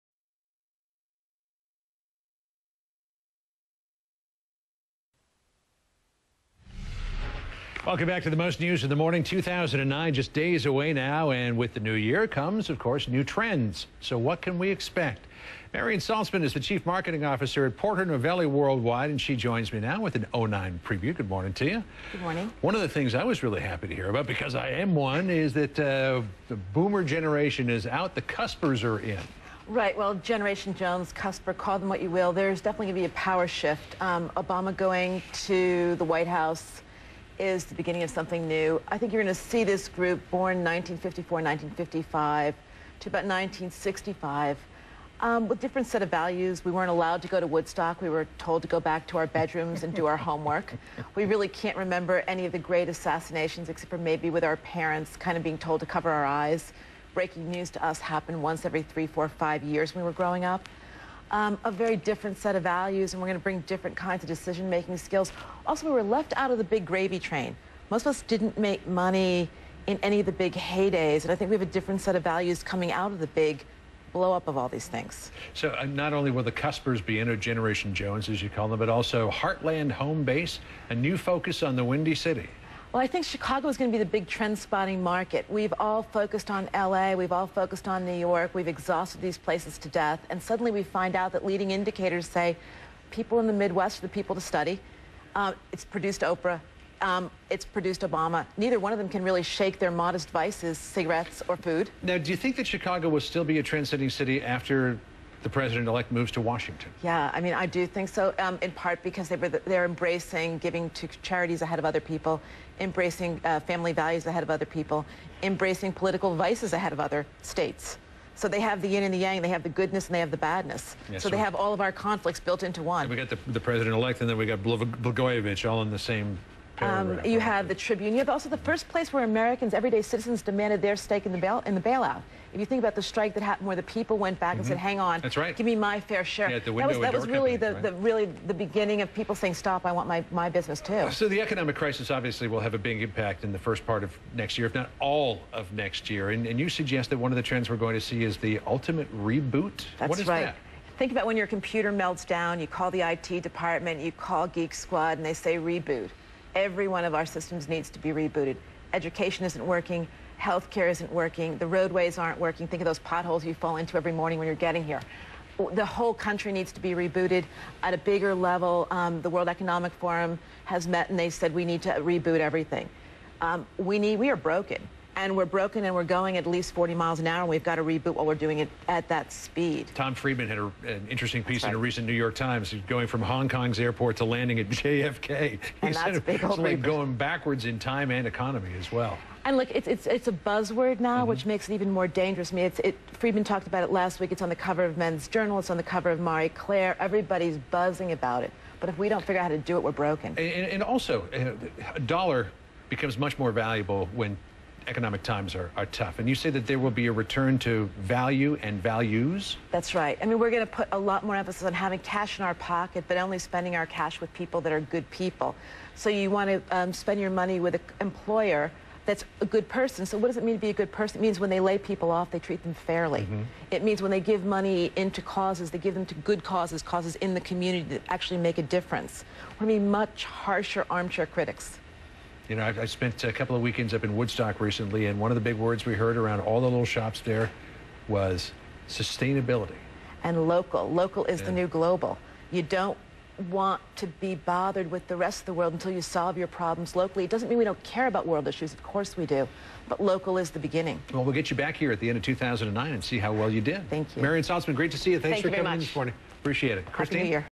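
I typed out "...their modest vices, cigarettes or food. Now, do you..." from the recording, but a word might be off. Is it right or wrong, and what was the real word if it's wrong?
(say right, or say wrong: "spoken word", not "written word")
right.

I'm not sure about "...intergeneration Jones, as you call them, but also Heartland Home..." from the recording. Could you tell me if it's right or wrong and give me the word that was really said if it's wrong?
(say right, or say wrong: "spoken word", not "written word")
right.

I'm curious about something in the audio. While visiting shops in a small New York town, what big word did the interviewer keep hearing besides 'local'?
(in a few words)
sustainability.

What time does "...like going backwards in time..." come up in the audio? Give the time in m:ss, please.
3:06.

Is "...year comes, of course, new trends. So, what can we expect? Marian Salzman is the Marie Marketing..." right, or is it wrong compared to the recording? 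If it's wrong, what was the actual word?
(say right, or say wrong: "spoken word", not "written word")
wrong: "Chief", not "Marie".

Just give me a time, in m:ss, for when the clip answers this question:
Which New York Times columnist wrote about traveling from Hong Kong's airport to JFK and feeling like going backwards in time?
2:59.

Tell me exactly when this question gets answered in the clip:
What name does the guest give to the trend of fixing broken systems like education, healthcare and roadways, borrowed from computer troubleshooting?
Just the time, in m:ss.
2:28.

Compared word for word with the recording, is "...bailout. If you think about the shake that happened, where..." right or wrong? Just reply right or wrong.
wrong.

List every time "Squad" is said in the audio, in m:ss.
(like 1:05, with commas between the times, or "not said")
2:34.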